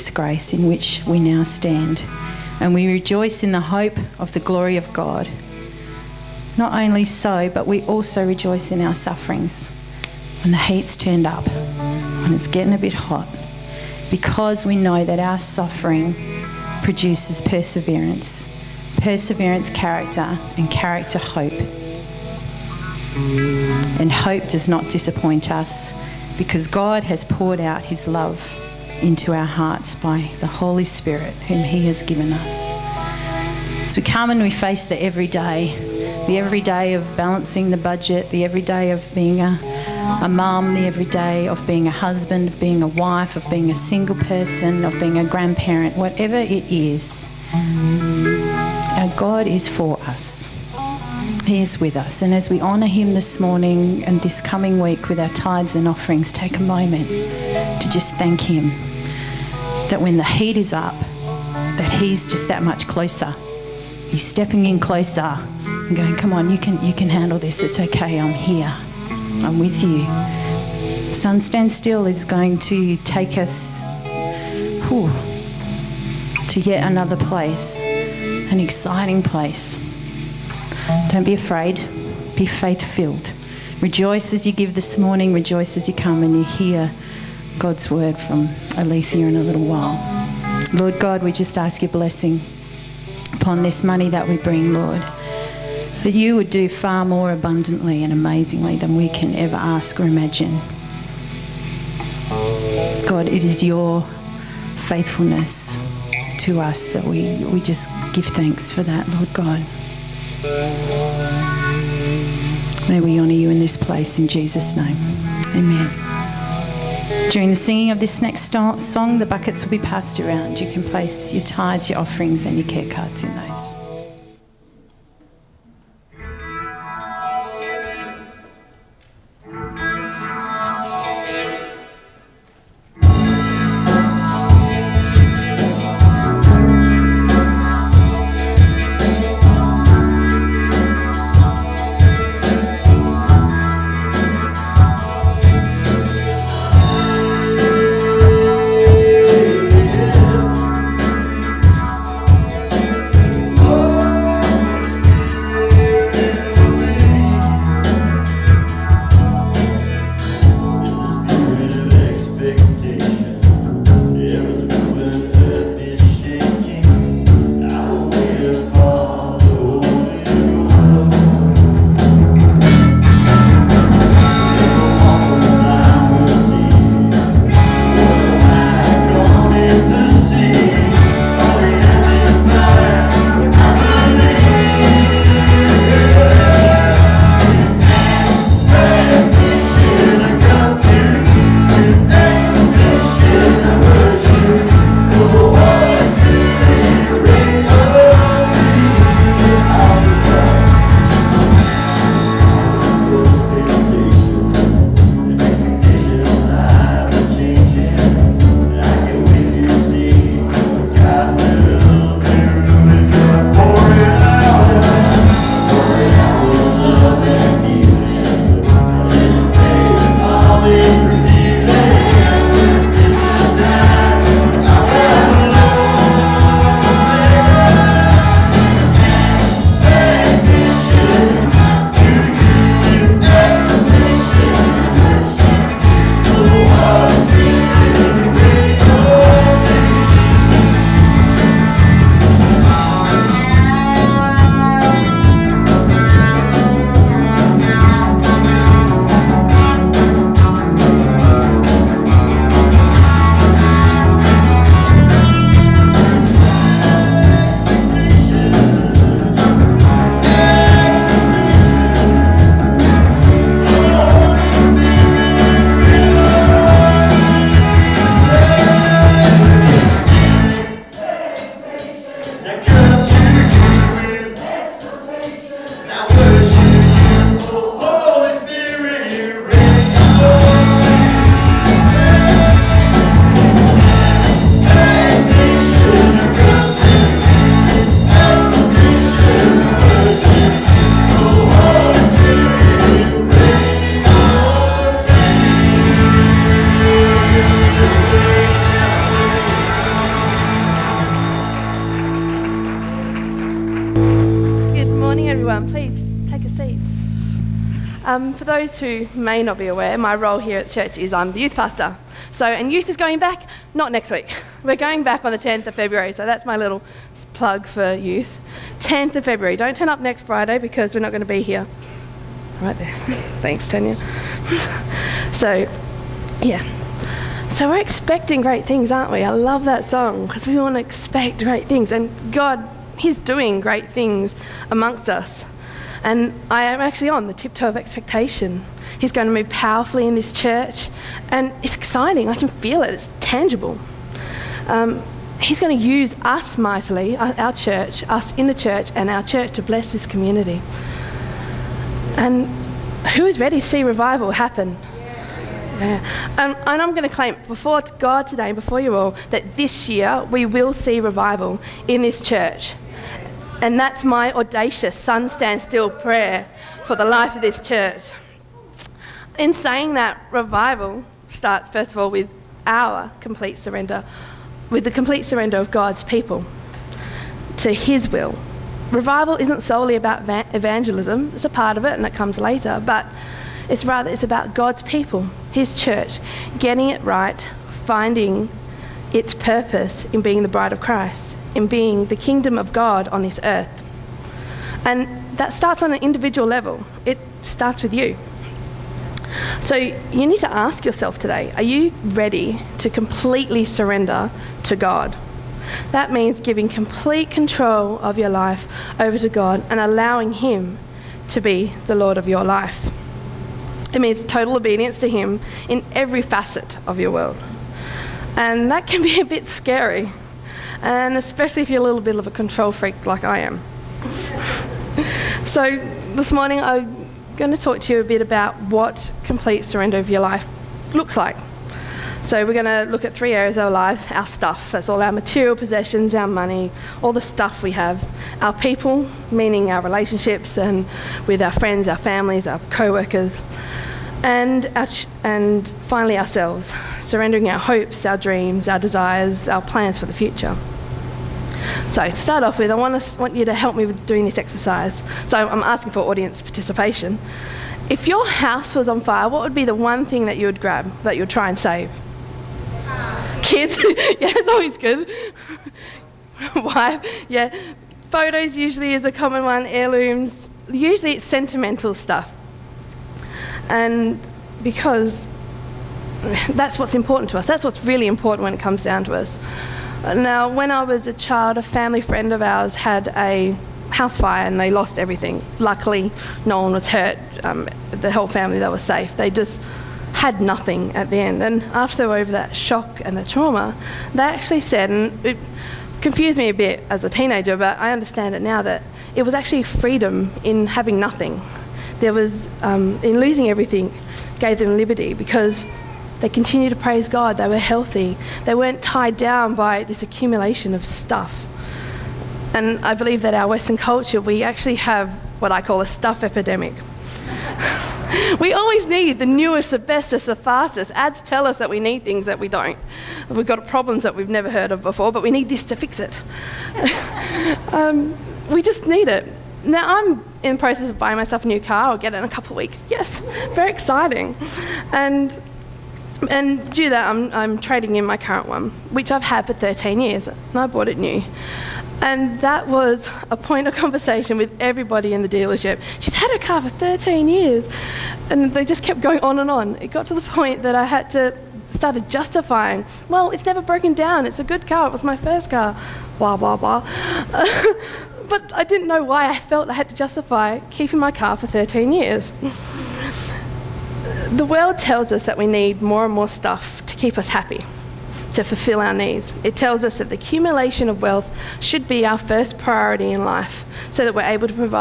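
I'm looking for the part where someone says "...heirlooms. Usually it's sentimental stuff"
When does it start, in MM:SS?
07:49.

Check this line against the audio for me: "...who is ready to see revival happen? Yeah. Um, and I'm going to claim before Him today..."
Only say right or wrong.
wrong.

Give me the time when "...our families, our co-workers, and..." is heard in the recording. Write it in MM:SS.
07:21.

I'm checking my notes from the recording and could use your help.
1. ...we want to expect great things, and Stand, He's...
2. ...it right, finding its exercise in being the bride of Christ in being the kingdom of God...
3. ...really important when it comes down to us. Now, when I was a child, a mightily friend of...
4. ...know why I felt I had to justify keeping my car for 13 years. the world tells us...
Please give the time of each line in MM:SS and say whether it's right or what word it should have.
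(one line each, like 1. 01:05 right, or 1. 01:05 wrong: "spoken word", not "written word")
1. 05:30 wrong: "God", not "Stand"
2. 06:26 wrong: "purpose", not "exercise"
3. 07:57 wrong: "family", not "mightily"
4. 09:18 right.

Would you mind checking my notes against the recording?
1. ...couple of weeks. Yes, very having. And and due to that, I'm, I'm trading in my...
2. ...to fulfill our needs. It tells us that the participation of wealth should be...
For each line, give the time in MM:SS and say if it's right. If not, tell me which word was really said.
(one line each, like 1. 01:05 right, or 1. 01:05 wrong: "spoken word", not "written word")
1. 08:52 wrong: "exciting", not "having"
2. 09:28 wrong: "accumulation", not "participation".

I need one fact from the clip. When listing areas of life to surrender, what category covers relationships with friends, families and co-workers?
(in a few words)
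our people.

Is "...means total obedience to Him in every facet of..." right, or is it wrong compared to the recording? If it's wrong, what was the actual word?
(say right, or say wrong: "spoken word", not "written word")
right.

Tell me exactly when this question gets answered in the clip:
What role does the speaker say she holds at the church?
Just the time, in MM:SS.
05:11.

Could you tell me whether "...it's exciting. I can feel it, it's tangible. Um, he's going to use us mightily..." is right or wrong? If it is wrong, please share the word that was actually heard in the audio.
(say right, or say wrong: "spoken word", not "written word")
right.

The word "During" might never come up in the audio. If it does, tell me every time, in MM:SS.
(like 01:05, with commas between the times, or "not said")
01:57.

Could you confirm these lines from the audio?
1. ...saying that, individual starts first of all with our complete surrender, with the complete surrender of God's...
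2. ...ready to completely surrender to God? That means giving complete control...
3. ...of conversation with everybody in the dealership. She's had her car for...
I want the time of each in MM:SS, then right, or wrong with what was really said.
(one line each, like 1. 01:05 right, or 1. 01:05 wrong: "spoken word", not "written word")
1. 06:09 wrong: "revival", not "individual"
2. 06:42 right
3. 09:03 right.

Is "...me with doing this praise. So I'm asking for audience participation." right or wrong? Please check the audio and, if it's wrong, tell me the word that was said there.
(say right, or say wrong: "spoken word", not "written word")
wrong: "exercise", not "praise".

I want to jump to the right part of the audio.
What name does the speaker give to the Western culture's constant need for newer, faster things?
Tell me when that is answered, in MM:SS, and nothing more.
08:35.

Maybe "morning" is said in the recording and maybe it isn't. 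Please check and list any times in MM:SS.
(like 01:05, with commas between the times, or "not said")
00:53, 01:24, 07:06.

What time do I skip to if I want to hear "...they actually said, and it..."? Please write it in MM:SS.
08:14.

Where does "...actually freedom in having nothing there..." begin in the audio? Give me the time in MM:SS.
08:19.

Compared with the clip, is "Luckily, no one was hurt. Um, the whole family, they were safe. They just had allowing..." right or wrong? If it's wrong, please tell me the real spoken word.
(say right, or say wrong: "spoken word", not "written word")
wrong: "nothing", not "allowing".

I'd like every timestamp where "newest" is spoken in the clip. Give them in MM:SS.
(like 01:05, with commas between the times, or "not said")
08:39.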